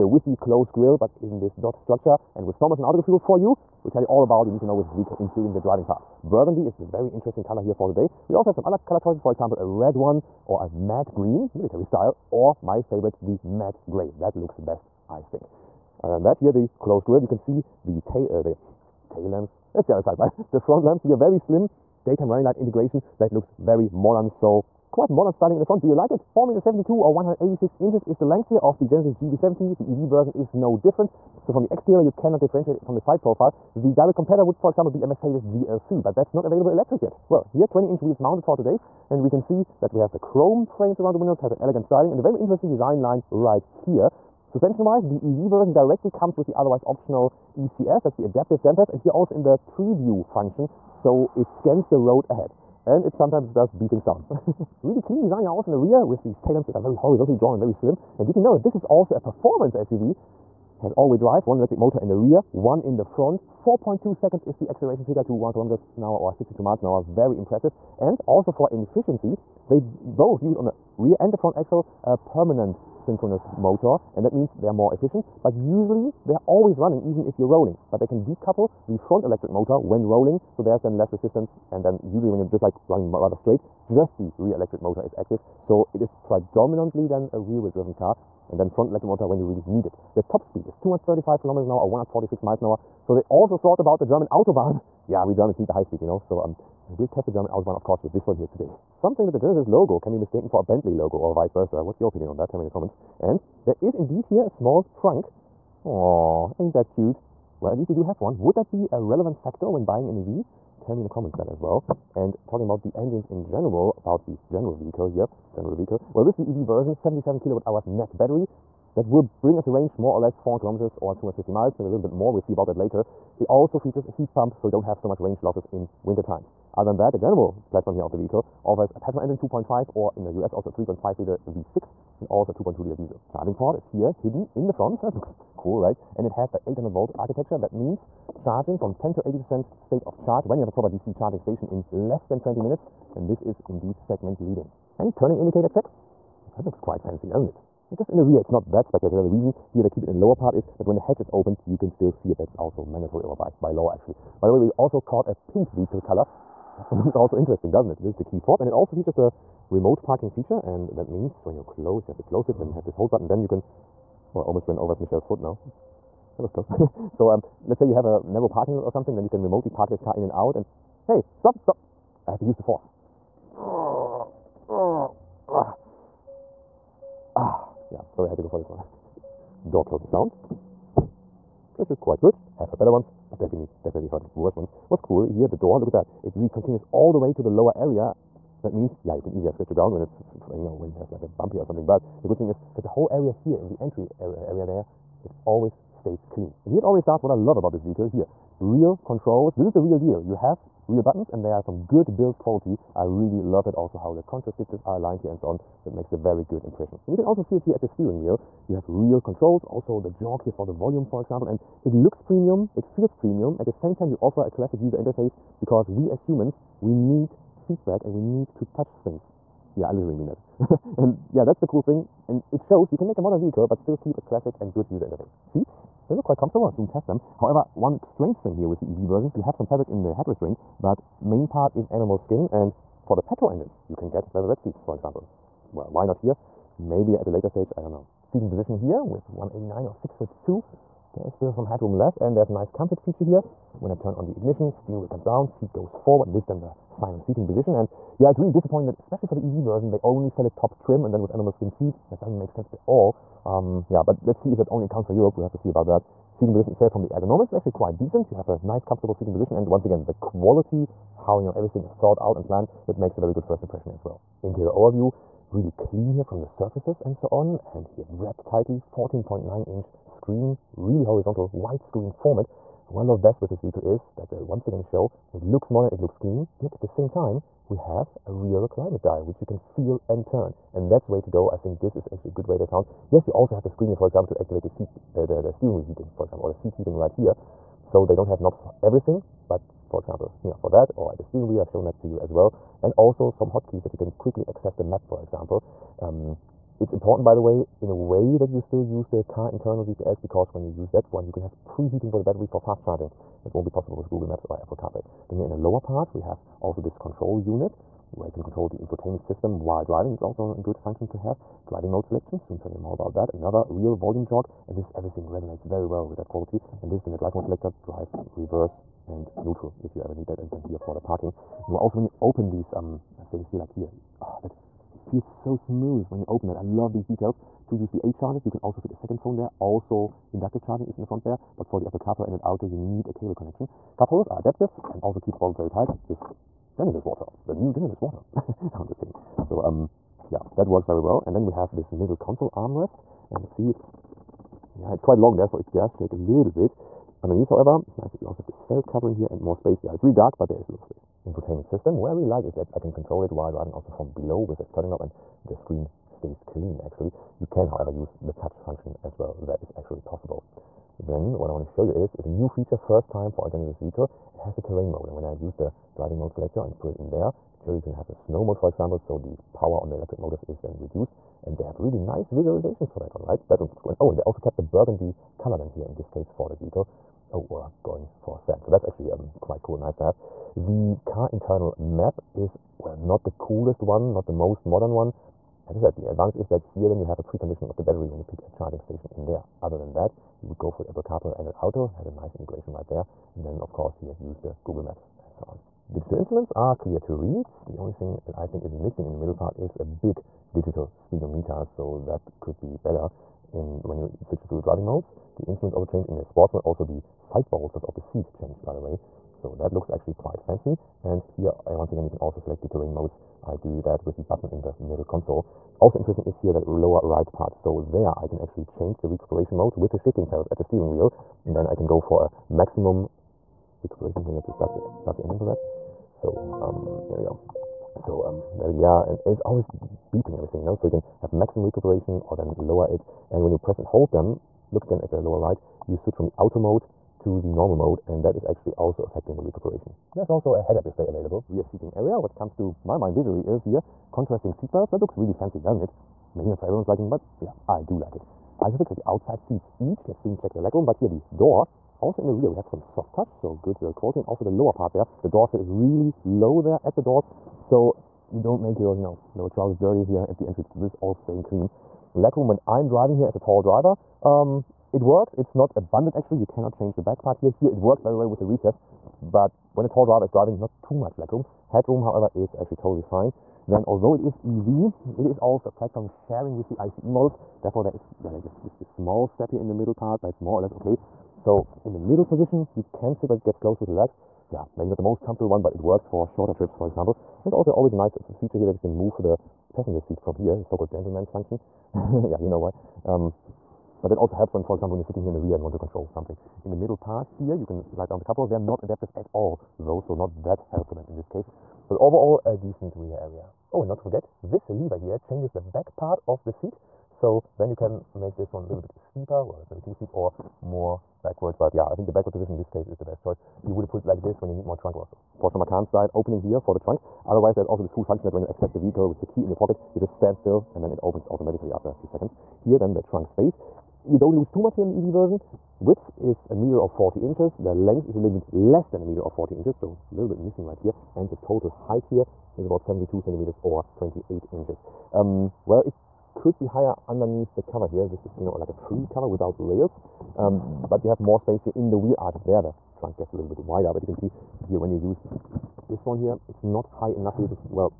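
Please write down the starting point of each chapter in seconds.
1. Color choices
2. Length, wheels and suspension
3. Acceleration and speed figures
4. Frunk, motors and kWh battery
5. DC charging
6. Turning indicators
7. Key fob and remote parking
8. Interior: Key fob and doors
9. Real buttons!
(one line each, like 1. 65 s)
1. 6 s
2. 26 s
3. 54 s
4. 98 s
5. 132 s
6. 144 s
7. 157 s
8. 178 s
9. 196 s.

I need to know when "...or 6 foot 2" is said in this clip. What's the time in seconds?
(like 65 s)
239 s.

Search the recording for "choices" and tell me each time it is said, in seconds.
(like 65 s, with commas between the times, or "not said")
8 s, 513 s.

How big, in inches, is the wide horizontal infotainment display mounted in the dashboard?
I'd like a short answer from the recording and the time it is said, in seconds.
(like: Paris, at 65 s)
14.9 inch, at 268 s.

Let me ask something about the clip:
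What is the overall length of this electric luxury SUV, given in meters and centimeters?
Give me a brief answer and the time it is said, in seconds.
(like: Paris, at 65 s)
4.72 m, at 26 s.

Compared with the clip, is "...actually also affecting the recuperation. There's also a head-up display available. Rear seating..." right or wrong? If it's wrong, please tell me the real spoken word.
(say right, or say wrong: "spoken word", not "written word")
right.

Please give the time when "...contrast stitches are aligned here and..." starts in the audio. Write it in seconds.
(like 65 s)
204 s.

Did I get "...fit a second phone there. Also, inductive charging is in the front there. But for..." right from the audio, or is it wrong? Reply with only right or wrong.
right.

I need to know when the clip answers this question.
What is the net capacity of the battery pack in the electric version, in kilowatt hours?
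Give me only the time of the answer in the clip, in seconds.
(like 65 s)
116 s.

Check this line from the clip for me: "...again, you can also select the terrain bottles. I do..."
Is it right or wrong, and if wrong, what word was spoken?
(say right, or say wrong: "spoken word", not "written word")
wrong: "modes", not "bottles".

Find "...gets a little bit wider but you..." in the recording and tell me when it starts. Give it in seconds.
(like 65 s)
543 s.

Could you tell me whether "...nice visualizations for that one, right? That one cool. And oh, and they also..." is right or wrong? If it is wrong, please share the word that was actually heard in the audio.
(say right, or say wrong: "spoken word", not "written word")
right.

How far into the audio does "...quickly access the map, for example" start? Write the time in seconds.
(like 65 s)
294 s.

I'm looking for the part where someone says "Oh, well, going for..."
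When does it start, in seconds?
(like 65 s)
377 s.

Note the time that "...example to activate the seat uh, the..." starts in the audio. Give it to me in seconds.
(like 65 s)
284 s.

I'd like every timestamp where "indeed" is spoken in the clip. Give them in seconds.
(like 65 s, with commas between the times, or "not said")
103 s, 143 s.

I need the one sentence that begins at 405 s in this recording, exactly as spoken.
The instruments also change in the sports mode.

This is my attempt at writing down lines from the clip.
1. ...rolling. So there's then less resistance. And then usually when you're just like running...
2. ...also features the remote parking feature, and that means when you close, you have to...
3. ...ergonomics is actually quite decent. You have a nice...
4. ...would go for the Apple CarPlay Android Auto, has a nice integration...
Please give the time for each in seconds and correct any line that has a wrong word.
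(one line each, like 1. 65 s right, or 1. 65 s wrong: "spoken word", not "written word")
1. 80 s right
2. 158 s right
3. 257 s right
4. 390 s right.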